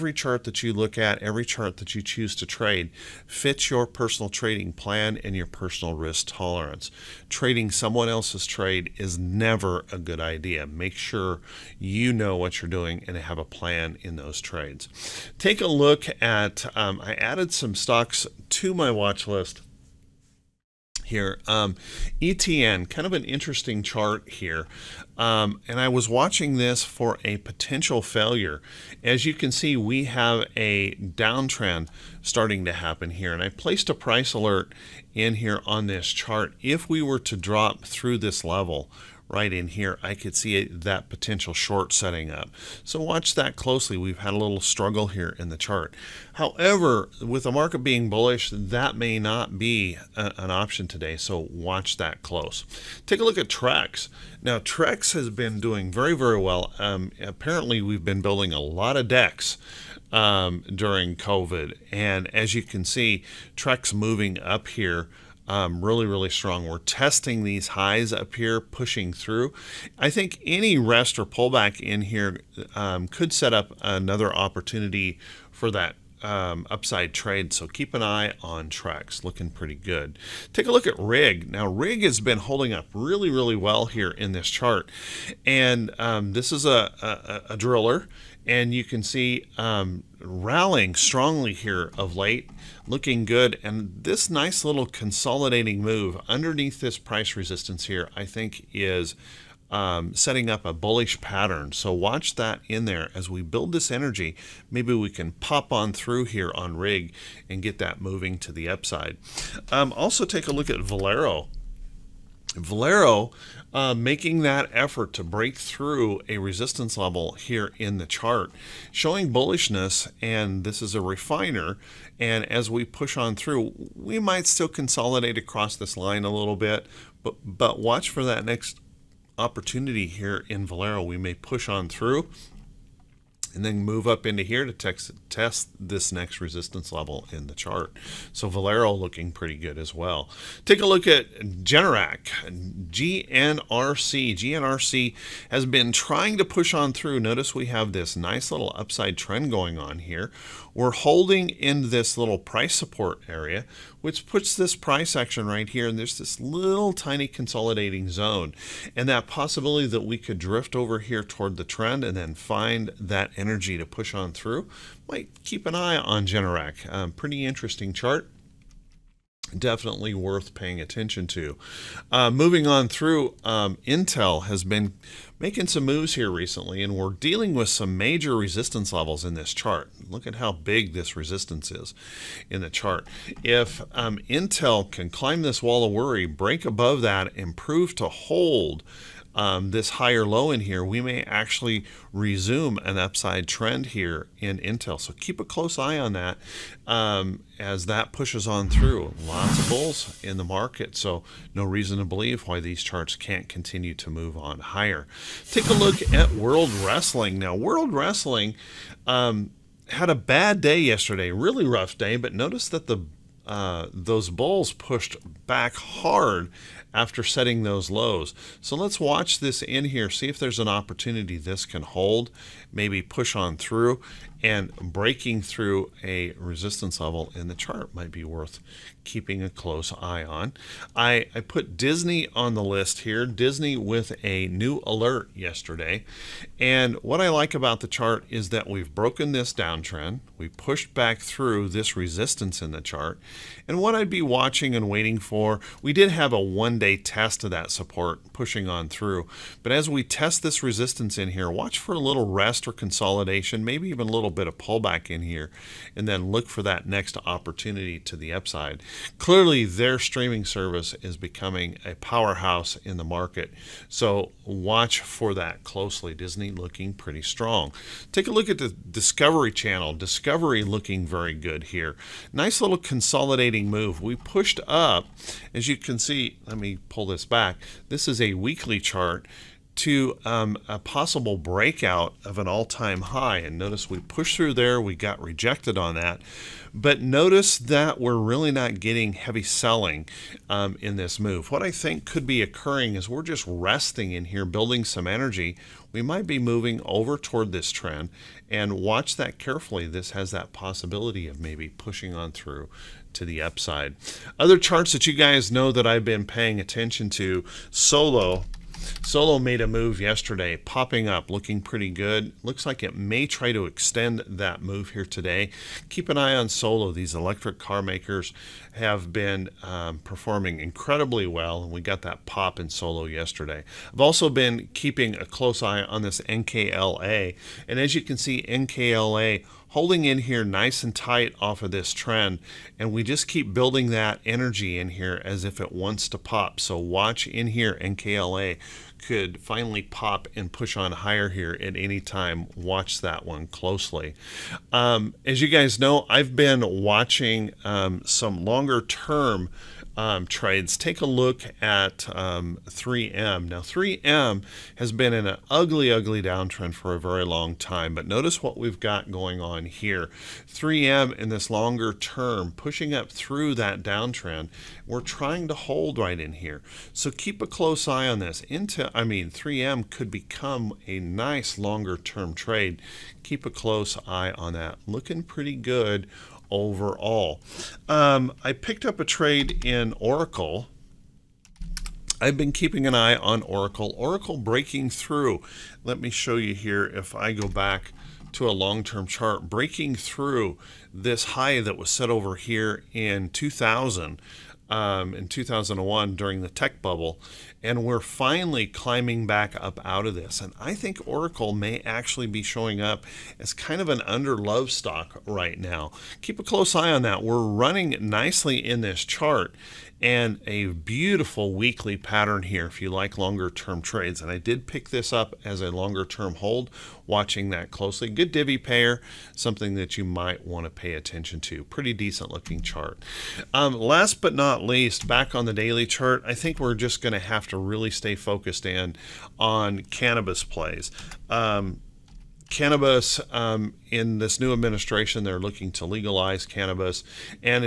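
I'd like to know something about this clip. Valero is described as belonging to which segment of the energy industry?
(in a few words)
refiner.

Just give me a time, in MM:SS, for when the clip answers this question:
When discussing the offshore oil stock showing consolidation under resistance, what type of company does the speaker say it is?
01:27.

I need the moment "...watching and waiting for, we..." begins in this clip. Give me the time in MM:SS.
04:04.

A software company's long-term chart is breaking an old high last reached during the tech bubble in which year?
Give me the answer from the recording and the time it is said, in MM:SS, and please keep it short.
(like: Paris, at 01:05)
2001, at 06:35.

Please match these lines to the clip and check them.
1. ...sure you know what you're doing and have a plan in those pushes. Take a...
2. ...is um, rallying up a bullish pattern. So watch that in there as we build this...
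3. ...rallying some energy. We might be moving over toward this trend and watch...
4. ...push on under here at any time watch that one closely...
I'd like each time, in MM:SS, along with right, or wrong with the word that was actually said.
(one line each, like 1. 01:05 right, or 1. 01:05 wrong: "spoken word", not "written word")
1. 00:10 wrong: "trades", not "pushes"
2. 01:38 wrong: "setting", not "rallying"
3. 04:54 wrong: "building", not "rallying"
4. 05:40 wrong: "higher", not "under".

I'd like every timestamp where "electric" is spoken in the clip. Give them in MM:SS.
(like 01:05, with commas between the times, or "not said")
05:17.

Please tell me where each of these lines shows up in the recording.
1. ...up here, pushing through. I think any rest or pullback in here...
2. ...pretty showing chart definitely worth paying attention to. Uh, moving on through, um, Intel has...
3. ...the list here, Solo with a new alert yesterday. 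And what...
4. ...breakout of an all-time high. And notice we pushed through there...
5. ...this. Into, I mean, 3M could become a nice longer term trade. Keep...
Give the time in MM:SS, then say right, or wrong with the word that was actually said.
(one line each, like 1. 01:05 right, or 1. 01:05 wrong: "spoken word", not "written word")
1. 01:08 right
2. 02:47 wrong: "interesting", not "showing"
3. 03:52 wrong: "Disney", not "Solo"
4. 04:41 right
5. 06:08 right.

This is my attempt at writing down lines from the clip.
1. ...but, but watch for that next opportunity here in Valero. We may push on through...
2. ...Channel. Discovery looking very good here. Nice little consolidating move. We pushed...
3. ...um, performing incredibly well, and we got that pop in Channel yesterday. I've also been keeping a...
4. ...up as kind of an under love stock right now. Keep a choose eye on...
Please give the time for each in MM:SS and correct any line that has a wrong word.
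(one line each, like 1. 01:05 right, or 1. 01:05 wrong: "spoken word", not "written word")
1. 02:07 right
2. 04:29 right
3. 05:19 wrong: "Solo", not "Channel"
4. 06:42 wrong: "close", not "choose".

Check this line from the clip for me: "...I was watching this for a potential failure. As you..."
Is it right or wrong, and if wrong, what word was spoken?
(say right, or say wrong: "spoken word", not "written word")
right.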